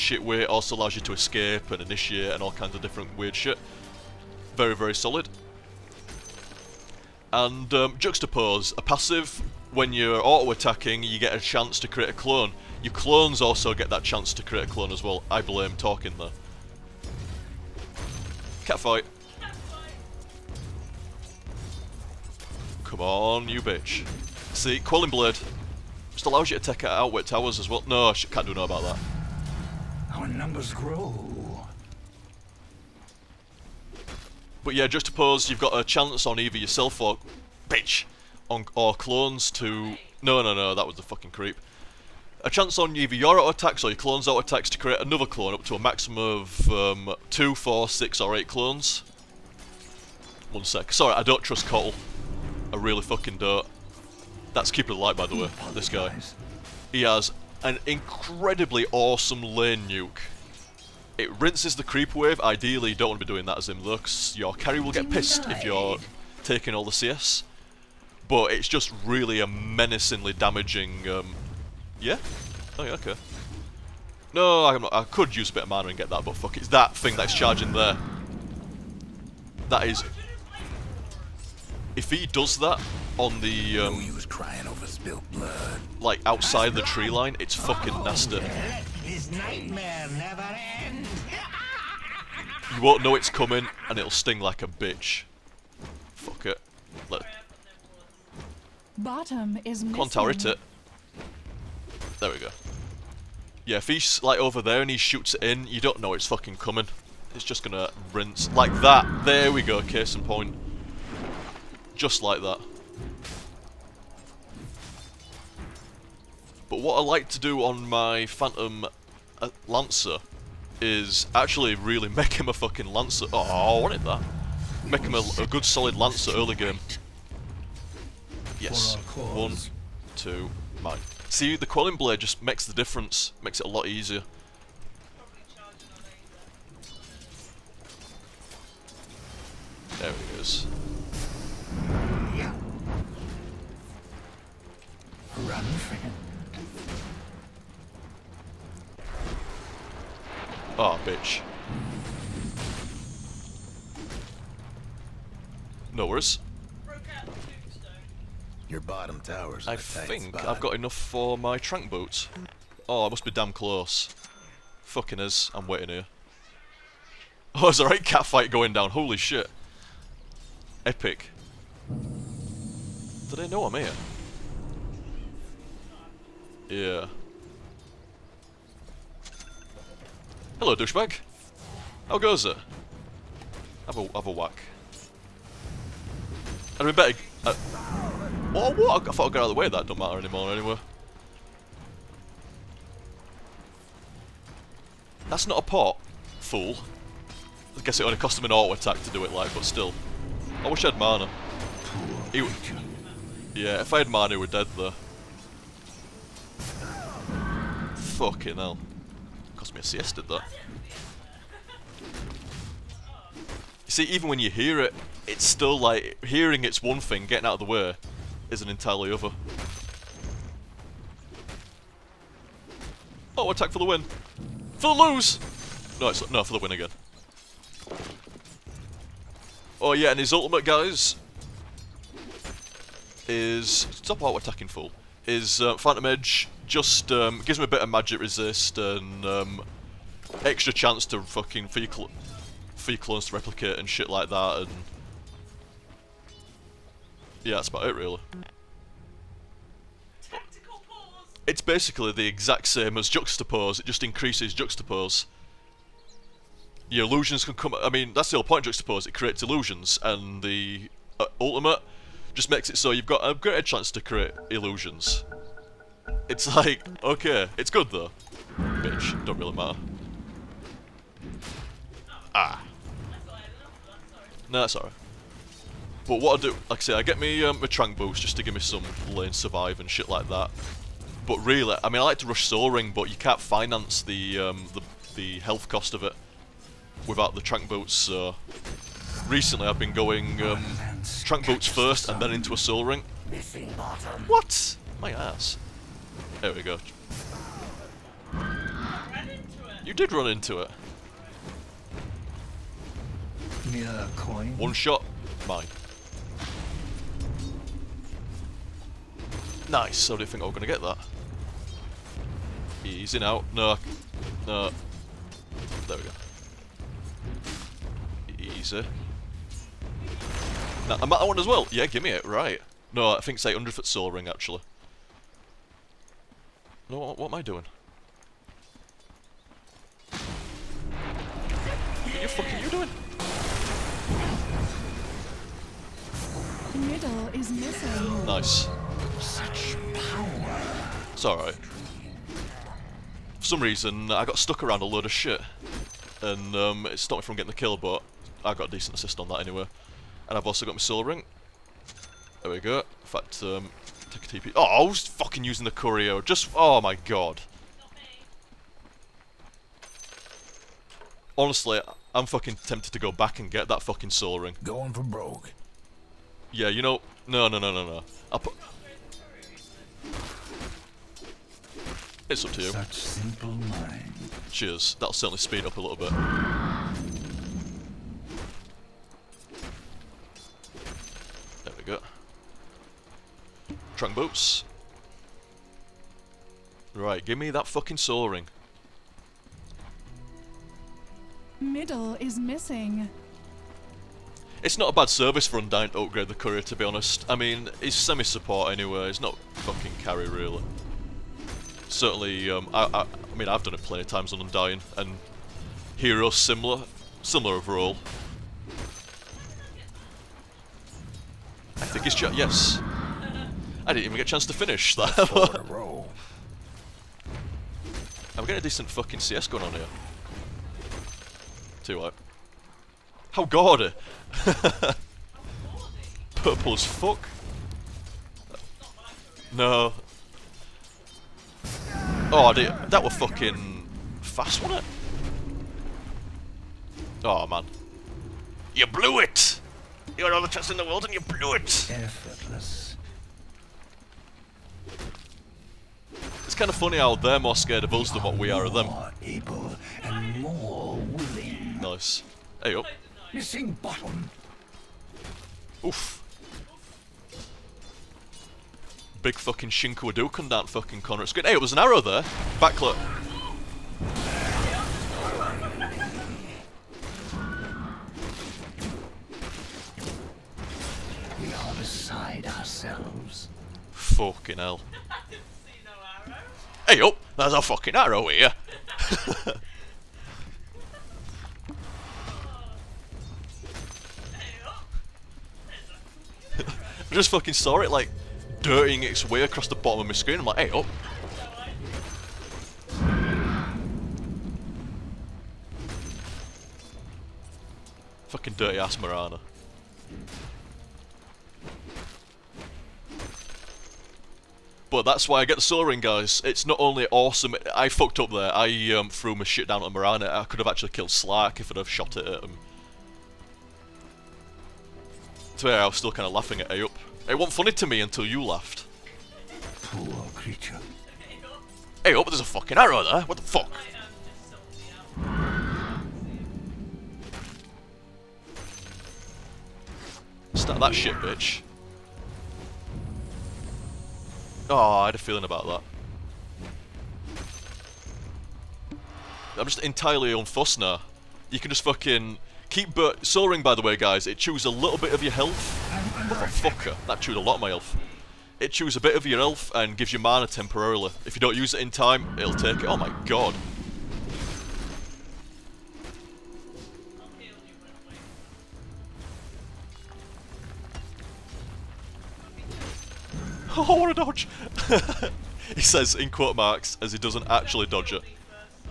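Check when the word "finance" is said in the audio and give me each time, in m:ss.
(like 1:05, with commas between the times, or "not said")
4:43.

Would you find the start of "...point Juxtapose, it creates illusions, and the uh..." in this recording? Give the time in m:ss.
4:18.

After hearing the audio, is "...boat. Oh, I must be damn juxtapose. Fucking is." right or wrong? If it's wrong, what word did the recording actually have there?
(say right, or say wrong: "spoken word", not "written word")
wrong: "close", not "juxtapose".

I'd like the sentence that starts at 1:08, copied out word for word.
But it's just really a menacingly damaging...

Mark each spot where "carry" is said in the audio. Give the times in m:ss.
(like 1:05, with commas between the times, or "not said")
1:04, 6:40.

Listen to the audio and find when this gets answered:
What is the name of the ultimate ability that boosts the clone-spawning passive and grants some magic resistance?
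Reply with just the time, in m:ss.
3:55.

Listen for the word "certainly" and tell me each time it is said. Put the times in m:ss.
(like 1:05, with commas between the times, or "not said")
6:15, 6:41.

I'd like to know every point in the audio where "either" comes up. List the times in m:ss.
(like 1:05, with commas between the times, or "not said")
0:36, 0:42.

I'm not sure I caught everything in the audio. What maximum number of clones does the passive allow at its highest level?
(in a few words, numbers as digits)
8.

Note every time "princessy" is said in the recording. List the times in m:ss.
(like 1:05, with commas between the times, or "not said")
not said.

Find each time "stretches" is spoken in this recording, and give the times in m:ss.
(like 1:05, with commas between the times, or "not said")
not said.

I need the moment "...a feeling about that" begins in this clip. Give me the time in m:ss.
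8:55.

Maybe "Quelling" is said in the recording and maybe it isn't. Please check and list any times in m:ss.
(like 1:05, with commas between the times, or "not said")
0:24, 2:11.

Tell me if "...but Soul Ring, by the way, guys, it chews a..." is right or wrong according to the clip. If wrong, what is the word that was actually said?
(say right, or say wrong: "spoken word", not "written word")
right.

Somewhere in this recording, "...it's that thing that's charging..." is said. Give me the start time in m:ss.
1:16.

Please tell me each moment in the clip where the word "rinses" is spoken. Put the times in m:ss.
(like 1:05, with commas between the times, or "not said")
1:01, 1:48.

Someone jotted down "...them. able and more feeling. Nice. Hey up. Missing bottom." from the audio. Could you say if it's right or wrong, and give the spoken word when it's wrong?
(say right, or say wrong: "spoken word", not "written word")
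wrong: "willing", not "feeling".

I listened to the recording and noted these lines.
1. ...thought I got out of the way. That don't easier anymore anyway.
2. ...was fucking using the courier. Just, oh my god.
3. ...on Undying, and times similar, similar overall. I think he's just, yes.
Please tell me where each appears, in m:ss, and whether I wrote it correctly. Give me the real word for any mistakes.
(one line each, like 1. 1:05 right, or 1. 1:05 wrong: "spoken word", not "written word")
1. 3:09 wrong: "matter", not "easier"
2. 5:54 right
3. 6:44 wrong: "heroes", not "times".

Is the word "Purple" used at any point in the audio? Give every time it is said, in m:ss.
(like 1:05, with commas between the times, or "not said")
7:06.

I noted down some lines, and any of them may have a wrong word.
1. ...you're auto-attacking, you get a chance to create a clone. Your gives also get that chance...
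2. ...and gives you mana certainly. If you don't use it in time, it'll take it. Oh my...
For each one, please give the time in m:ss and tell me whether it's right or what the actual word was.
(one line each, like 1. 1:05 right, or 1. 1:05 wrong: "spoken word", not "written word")
1. 0:09 wrong: "clones", not "gives"
2. 9:09 wrong: "temporarily", not "certainly".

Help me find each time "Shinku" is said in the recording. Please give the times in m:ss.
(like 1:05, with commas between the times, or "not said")
7:39.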